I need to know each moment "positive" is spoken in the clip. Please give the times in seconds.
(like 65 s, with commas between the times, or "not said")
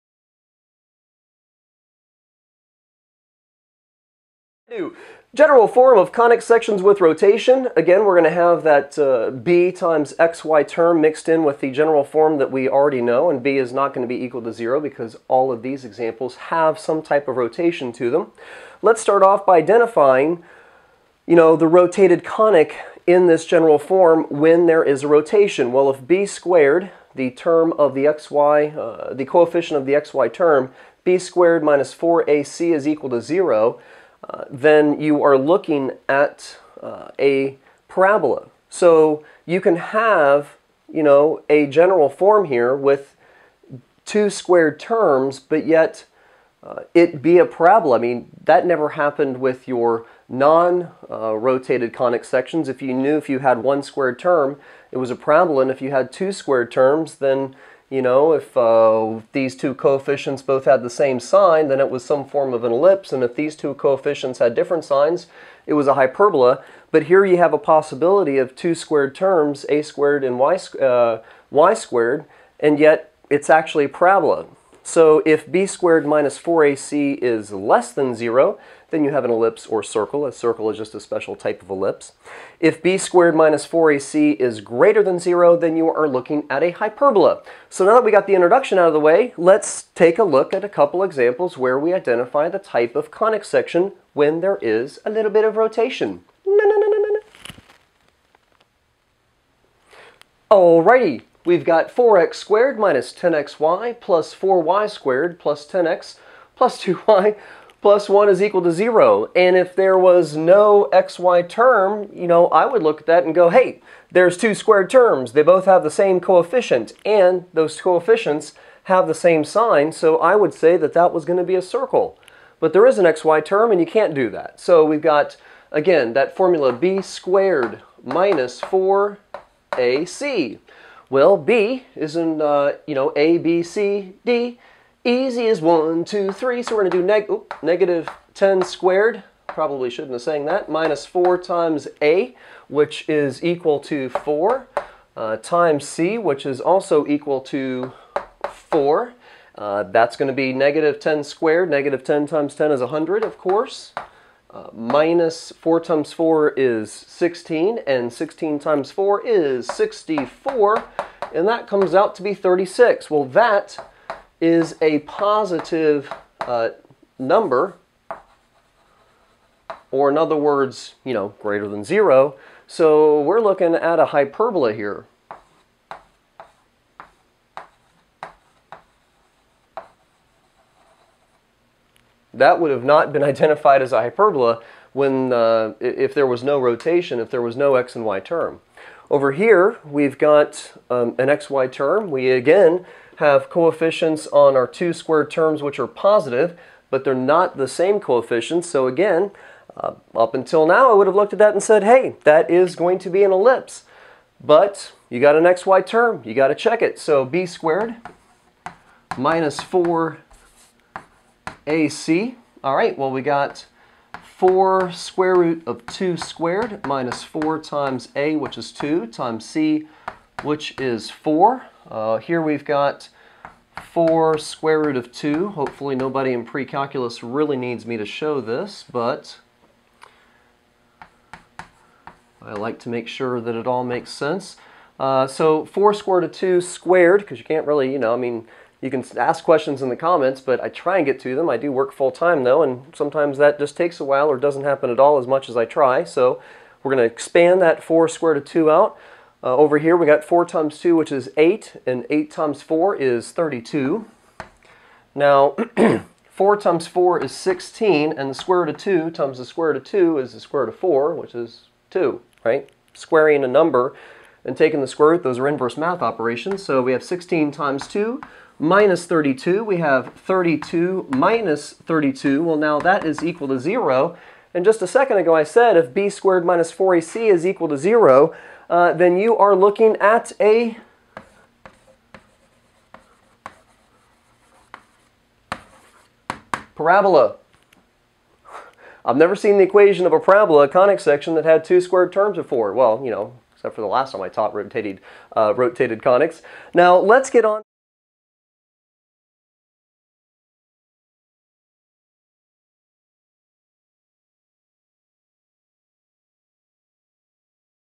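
164 s, 195 s.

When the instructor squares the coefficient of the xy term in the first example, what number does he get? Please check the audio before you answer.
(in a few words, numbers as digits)
100.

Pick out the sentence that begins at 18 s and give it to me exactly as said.
Let's start off by identifying, you know, the rotated conic in this general form when there is a rotation.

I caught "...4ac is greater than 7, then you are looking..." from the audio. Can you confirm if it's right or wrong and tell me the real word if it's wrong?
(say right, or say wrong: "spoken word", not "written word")
wrong: "0", not "7".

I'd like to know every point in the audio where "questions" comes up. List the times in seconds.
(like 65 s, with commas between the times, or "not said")
239 s.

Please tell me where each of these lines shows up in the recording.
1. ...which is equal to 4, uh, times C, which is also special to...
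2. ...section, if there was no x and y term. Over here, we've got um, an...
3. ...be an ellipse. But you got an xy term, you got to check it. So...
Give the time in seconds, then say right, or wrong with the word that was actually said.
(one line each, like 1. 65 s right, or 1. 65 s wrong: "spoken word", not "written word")
1. 142 s wrong: "equal", not "special"
2. 186 s wrong: "rotation", not "section"
3. 203 s right.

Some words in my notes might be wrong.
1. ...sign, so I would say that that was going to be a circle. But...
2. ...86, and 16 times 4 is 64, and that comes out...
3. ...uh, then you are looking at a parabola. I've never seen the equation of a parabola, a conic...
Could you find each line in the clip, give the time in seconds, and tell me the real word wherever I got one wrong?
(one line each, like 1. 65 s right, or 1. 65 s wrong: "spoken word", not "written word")
1. 119 s right
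2. 156 s wrong: "16", not "86"
3. 278 s right.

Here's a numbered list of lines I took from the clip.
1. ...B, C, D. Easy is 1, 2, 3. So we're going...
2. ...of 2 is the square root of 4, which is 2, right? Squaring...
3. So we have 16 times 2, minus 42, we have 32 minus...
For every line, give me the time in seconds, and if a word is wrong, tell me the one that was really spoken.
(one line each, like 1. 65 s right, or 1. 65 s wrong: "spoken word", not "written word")
1. 133 s right
2. 259 s right
3. 266 s wrong: "32", not "42".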